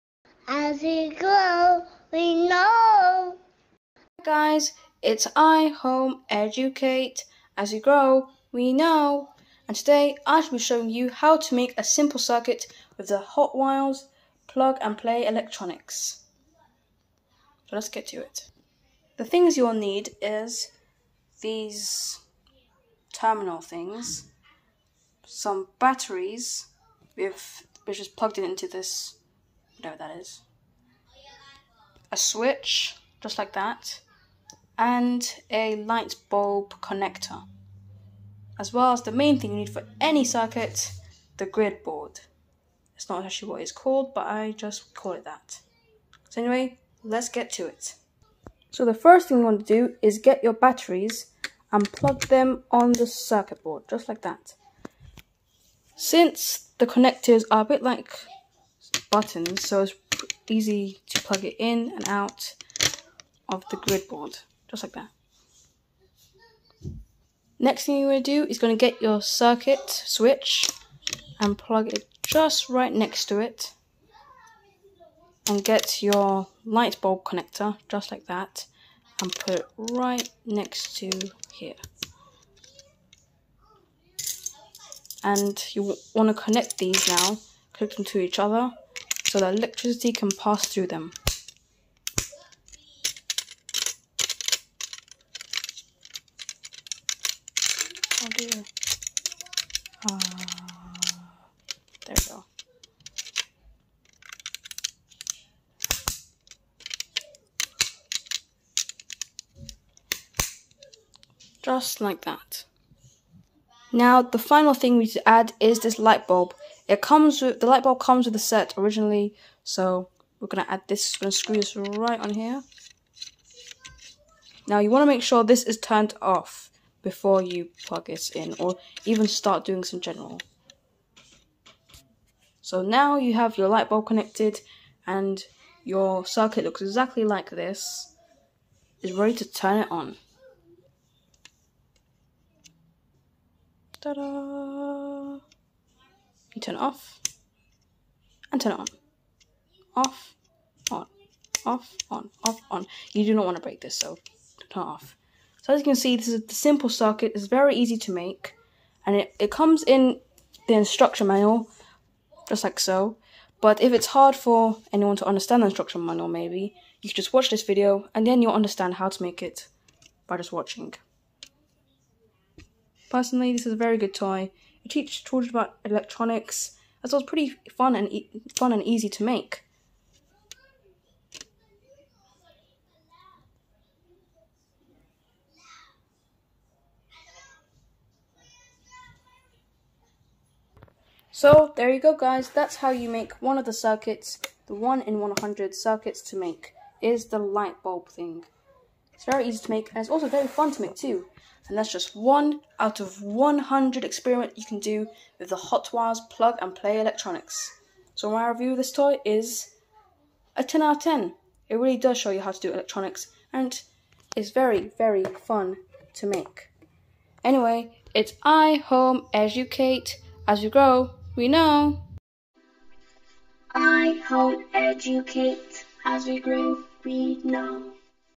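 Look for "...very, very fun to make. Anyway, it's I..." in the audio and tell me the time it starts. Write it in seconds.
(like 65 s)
214 s.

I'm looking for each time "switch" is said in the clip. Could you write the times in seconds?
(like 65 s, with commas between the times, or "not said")
32 s, 69 s.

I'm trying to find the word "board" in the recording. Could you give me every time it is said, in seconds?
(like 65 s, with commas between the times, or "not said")
41 s, 53 s, 64 s.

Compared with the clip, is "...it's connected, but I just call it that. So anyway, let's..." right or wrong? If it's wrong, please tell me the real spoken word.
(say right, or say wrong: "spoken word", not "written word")
wrong: "called", not "connected".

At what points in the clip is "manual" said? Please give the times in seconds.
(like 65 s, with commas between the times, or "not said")
161 s, 166 s.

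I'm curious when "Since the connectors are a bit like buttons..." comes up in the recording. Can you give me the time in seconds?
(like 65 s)
55 s.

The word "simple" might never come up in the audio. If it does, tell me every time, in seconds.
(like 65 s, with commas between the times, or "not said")
11 s, 156 s.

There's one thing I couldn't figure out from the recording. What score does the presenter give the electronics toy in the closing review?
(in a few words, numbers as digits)
10 out of 10.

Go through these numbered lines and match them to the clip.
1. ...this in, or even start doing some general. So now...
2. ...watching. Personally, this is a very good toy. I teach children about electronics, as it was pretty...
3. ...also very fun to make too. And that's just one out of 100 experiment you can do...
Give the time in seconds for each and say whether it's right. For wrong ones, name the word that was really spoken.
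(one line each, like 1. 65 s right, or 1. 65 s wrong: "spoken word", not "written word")
1. 128 s right
2. 170 s right
3. 200 s right.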